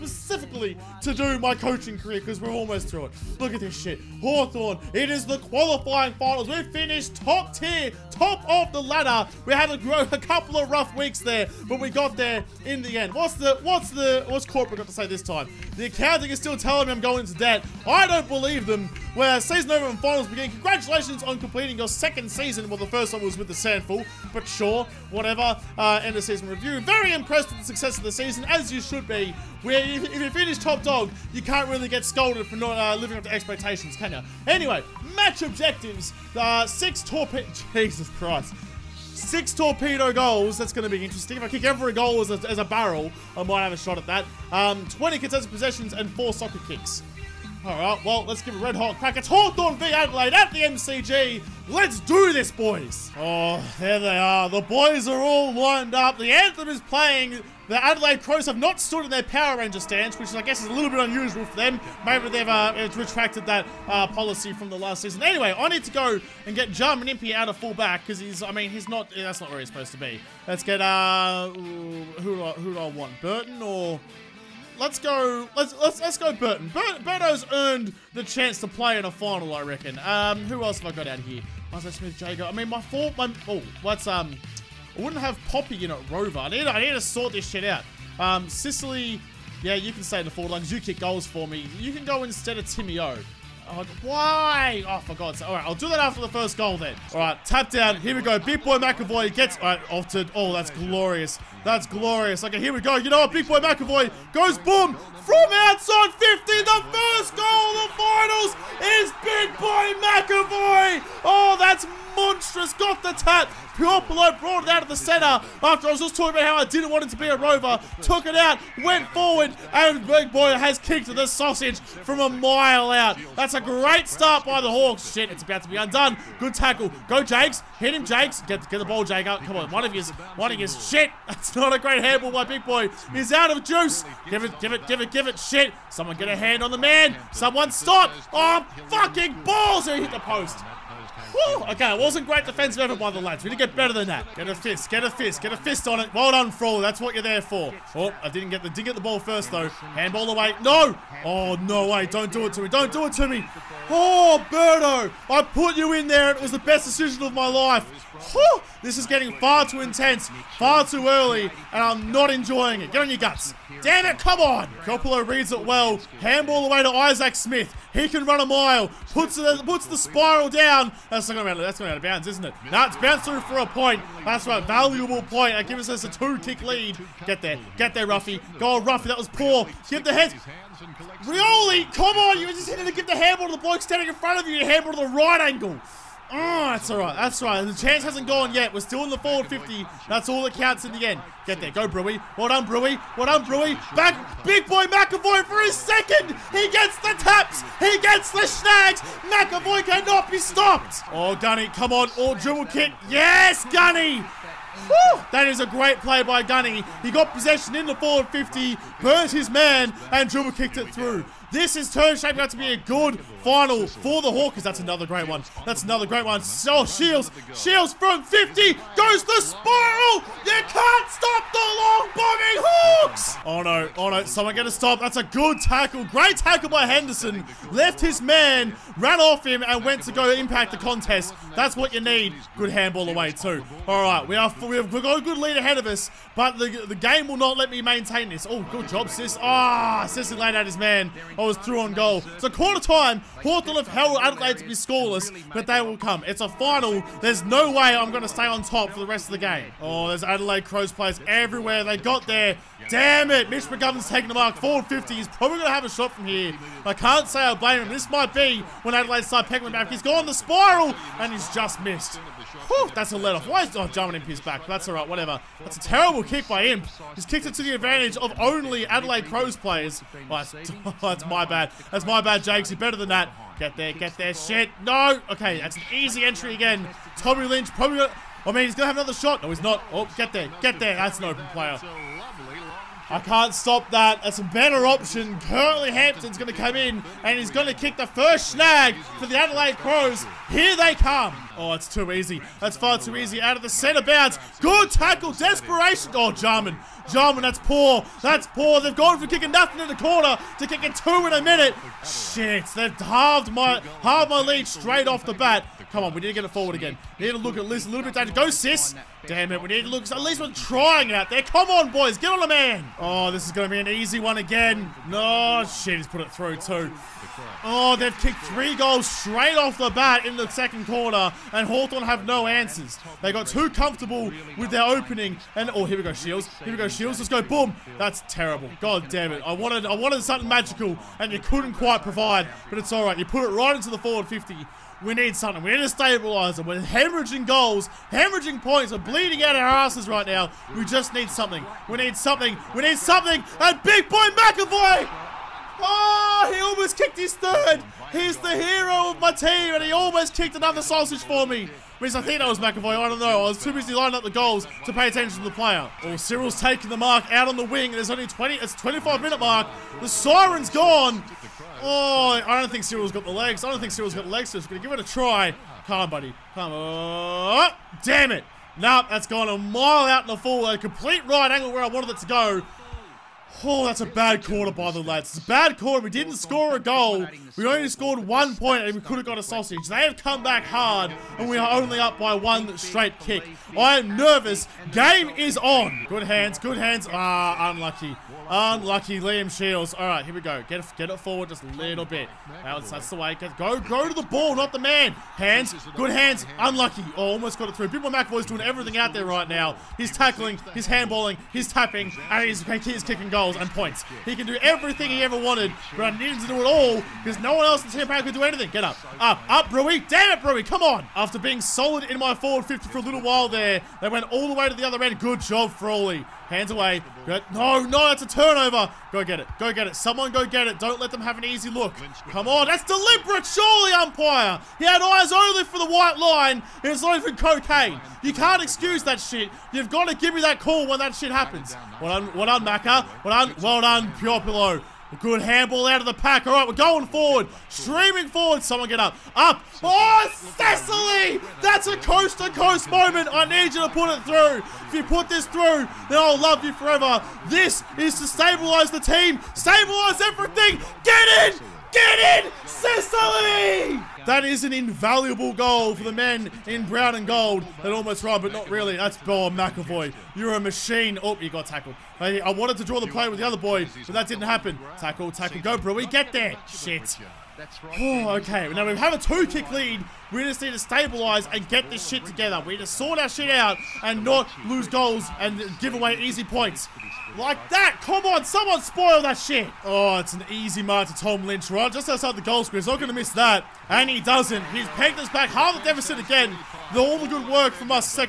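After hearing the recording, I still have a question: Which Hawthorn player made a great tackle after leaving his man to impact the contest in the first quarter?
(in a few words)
Henderson.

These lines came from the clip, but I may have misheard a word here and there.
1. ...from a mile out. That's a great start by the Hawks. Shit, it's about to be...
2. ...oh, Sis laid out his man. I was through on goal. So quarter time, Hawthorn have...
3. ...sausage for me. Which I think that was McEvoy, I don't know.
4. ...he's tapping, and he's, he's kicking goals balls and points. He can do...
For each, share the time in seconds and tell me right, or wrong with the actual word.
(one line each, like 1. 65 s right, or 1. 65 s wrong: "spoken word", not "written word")
1. 121 s right
2. 240 s right
3. 350 s right
4. 401 s wrong: "goals", not "balls".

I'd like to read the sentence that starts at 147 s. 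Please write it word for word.
Oh, I didn't get the dig at the ball first, though.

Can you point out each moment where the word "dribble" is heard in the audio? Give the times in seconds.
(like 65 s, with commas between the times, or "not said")
202 s, 210 s.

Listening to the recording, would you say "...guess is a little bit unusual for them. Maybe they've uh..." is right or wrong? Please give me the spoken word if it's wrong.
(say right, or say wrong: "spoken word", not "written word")
right.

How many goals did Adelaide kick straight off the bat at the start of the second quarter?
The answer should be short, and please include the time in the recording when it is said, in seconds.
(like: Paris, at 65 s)
3, at 318 s.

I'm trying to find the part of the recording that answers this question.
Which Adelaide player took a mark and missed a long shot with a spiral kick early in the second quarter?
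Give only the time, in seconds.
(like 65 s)
253 s.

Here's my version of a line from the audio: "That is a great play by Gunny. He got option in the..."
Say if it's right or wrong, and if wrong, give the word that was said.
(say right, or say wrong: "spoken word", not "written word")
wrong: "possession", not "option".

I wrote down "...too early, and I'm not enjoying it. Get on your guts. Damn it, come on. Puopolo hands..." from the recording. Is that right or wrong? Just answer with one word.
wrong.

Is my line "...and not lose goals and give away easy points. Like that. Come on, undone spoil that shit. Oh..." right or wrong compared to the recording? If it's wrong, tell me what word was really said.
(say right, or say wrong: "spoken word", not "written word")
wrong: "someone", not "undone".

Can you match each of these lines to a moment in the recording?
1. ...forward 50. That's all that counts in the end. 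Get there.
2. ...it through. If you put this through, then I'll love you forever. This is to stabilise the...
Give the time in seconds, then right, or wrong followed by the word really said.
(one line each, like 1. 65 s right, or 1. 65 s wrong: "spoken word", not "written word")
1. 189 s right
2. 444 s right.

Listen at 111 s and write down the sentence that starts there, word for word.
Oh, that's monstrous got the tap.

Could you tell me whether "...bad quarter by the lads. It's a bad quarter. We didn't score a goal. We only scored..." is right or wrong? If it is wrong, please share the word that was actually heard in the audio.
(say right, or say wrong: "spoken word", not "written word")
right.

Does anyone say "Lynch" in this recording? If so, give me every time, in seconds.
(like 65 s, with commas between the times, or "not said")
277 s, 481 s.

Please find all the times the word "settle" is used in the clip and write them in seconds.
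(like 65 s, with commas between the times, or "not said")
not said.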